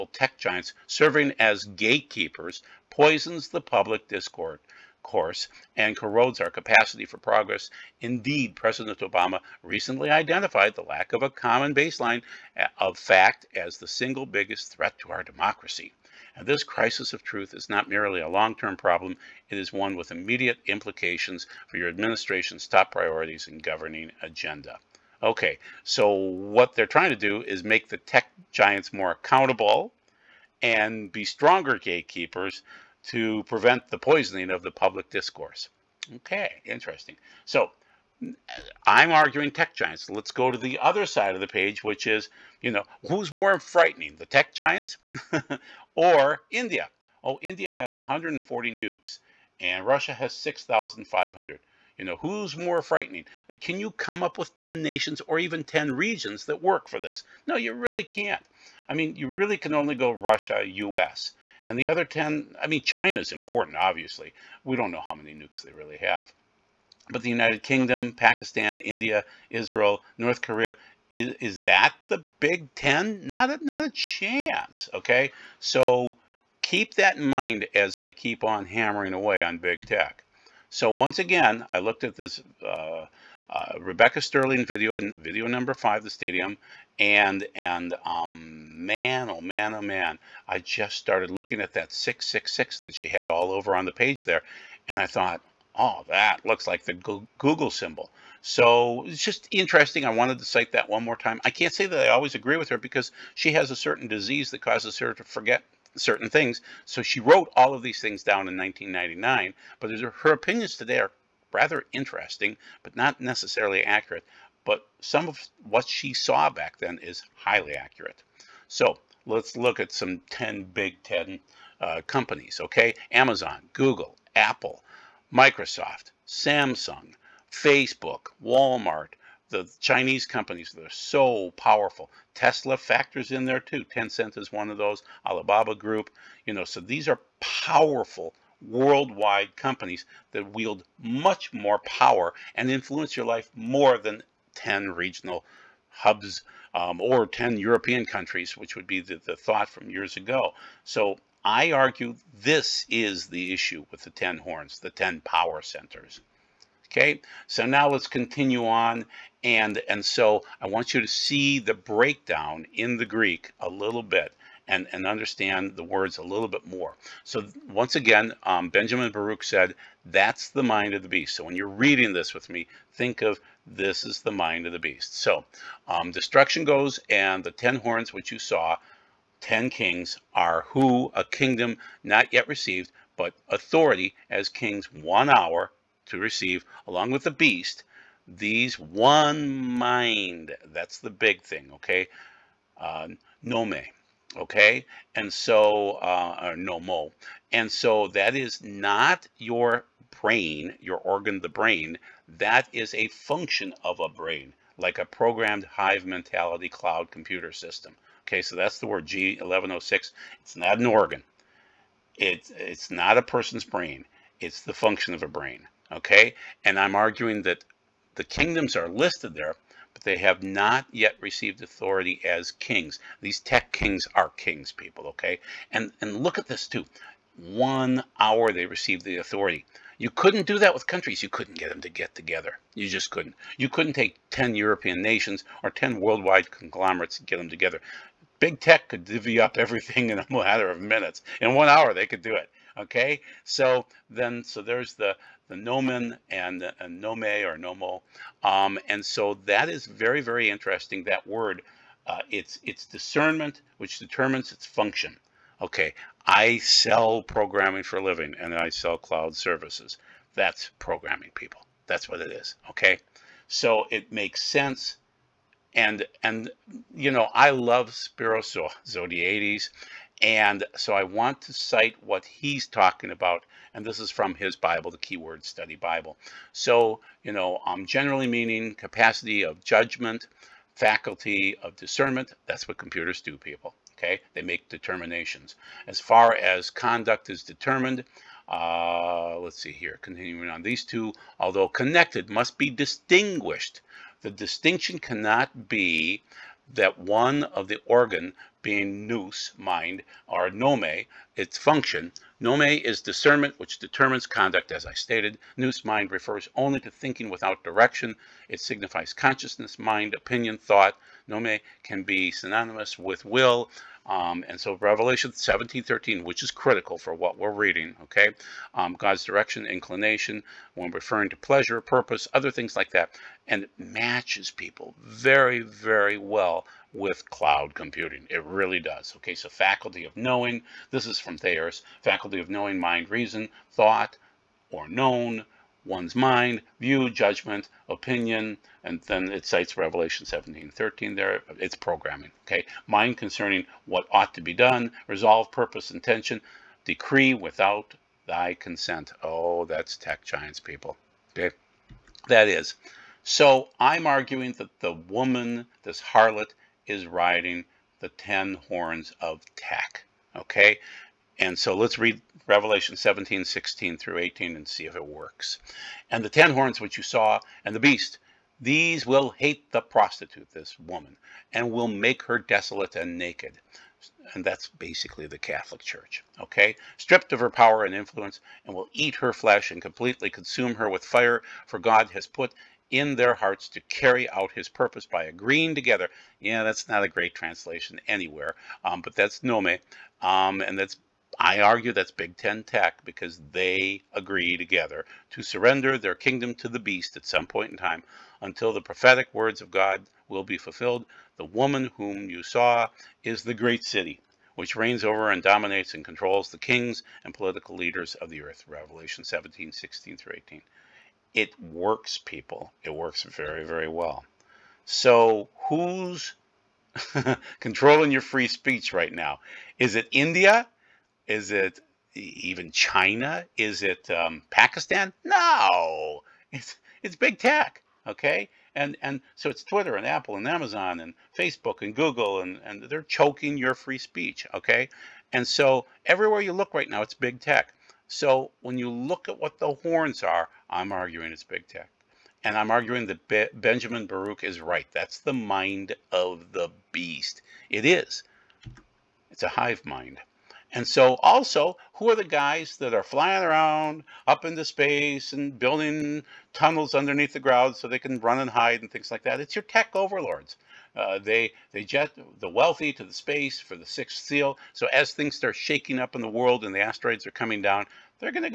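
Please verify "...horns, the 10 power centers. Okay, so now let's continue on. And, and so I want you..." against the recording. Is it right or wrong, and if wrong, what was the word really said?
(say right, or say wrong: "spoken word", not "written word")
right.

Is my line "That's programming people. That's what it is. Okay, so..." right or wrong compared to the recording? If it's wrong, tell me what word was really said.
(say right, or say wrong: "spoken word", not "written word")
right.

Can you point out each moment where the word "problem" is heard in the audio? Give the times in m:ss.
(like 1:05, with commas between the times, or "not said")
0:18.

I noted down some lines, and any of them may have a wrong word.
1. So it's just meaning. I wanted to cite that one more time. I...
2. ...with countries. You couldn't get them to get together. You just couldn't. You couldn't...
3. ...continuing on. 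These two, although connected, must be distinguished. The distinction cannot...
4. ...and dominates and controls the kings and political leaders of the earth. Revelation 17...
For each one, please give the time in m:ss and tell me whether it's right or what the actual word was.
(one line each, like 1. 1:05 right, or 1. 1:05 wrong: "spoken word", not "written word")
1. 1:38 wrong: "interesting", not "meaning"
2. 3:50 right
3. 4:50 right
4. 6:45 right.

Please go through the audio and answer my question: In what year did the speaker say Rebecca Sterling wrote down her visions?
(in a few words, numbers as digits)
1999.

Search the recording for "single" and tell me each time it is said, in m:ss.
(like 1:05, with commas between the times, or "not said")
0:13.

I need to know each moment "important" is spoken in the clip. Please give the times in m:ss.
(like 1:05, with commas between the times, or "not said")
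1:03.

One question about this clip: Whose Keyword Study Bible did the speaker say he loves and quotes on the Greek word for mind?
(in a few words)
Spiro Zodhiates.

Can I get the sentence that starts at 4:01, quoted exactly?
In one hour, they could do it.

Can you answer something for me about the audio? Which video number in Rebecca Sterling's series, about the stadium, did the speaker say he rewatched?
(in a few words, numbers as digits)
5.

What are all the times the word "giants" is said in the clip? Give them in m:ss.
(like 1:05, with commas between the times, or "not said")
0:00, 0:28, 0:39, 0:44, 5:50.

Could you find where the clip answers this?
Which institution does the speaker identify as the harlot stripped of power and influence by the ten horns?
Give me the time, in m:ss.
6:15.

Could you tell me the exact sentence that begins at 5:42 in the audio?
Mind concerning what ought to be done, resolve, purpose, intention, decree without thy consent.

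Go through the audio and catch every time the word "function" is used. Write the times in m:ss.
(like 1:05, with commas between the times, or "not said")
3:23, 3:34, 4:14, 5:01.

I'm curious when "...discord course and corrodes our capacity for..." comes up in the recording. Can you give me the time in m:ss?
0:04.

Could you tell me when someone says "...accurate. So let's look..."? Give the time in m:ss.
1:57.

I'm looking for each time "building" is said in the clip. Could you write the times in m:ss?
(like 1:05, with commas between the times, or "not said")
7:35.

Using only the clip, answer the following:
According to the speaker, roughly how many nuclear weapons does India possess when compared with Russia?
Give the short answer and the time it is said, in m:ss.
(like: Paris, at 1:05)
140, at 0:47.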